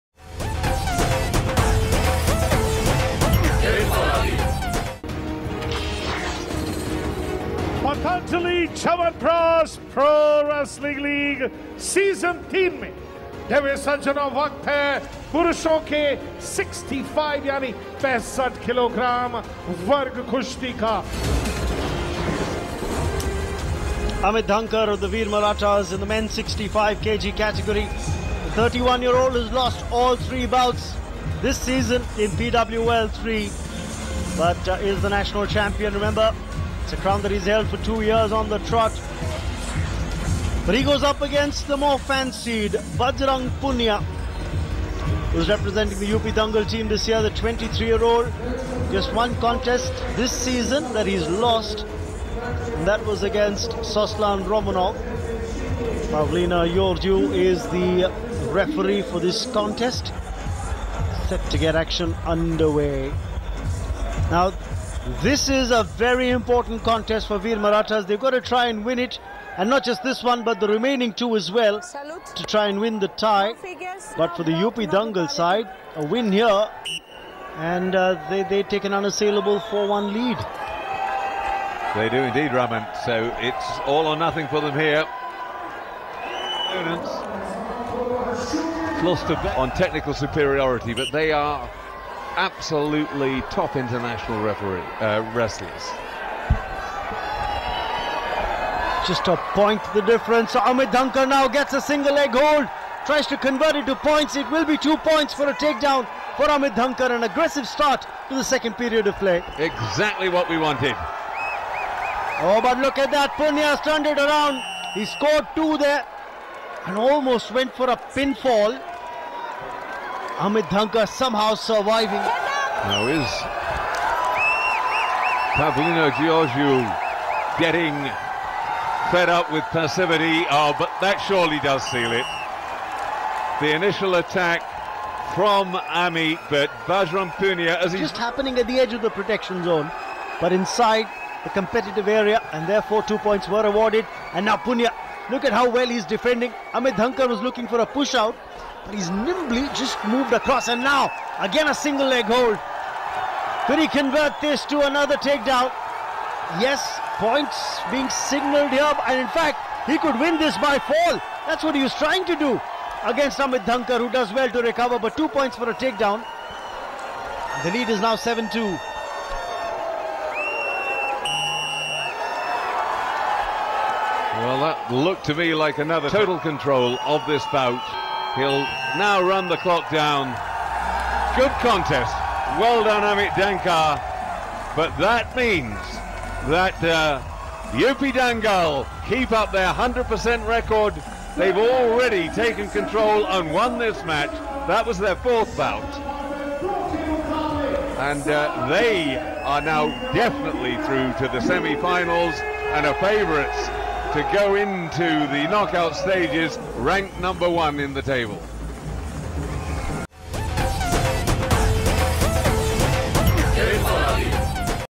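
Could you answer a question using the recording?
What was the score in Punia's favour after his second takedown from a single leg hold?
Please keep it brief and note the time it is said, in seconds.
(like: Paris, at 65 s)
7-2, at 168 s.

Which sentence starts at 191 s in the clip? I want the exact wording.
They've already taken control and won this match.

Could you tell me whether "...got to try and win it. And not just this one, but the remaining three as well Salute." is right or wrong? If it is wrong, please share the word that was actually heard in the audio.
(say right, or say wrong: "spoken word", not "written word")
wrong: "two", not "three".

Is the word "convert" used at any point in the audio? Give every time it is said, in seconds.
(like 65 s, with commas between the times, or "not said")
103 s, 153 s.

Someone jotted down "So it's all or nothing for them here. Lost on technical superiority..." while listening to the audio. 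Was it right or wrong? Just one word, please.
right.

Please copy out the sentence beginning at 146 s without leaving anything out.
Amit Dhankar was looking for a push out, but he's nimbly just moved across.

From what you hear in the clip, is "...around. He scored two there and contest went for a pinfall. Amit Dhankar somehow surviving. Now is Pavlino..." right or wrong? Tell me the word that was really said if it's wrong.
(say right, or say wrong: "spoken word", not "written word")
wrong: "almost", not "contest".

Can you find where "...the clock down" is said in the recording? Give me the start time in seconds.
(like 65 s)
179 s.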